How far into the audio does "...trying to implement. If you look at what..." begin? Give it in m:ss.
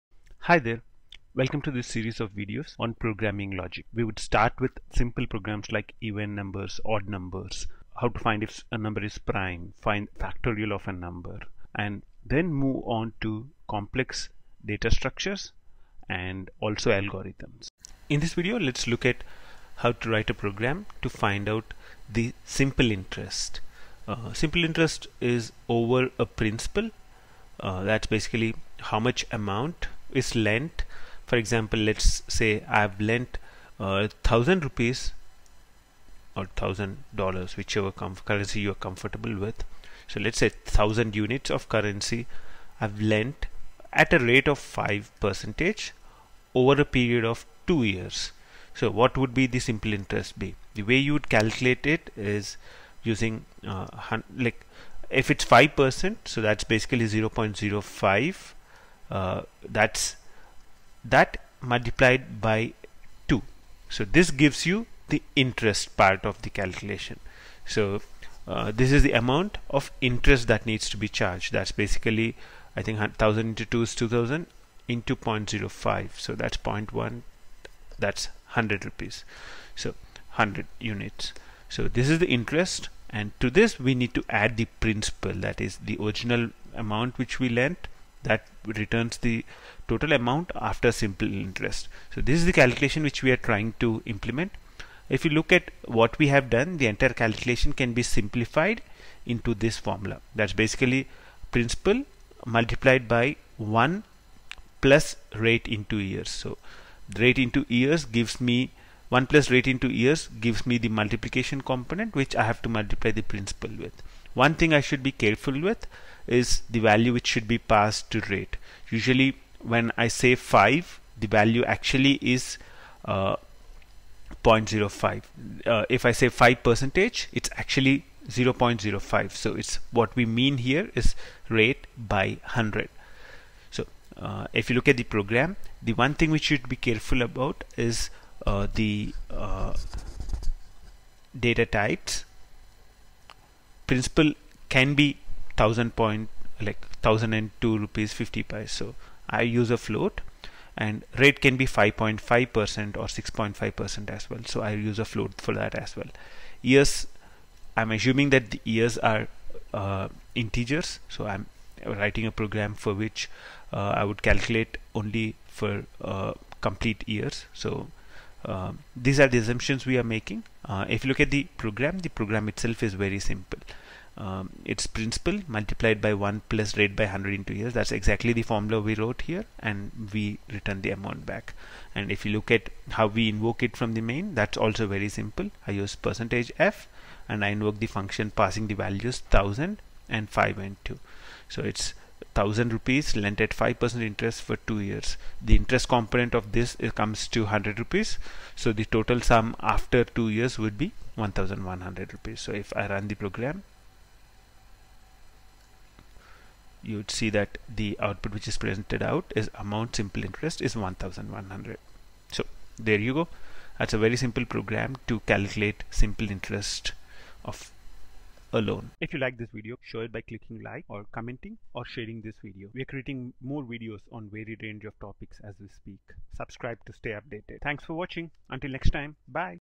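1:33.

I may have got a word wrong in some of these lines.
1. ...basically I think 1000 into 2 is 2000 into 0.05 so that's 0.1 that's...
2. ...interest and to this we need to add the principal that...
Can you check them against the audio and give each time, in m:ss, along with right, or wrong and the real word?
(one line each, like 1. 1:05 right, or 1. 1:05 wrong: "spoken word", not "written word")
1. 1:11 right
2. 1:22 right.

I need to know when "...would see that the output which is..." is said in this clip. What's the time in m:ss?
3:26.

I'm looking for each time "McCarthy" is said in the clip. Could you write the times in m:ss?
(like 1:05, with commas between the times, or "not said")
not said.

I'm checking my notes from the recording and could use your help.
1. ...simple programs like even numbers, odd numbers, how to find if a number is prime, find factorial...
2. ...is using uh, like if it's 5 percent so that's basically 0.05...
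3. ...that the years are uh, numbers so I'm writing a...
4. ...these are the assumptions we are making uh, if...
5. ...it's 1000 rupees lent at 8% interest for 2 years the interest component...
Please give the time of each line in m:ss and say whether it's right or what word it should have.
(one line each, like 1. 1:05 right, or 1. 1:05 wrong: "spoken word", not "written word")
1. 0:04 right
2. 0:52 right
3. 2:38 wrong: "integers", not "numbers"
4. 2:48 right
5. 3:11 wrong: "5", not "8".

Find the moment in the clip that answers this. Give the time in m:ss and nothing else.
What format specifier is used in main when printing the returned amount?
3:05.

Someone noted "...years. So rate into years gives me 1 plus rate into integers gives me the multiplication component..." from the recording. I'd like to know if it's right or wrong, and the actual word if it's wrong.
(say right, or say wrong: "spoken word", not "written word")
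wrong: "years", not "integers".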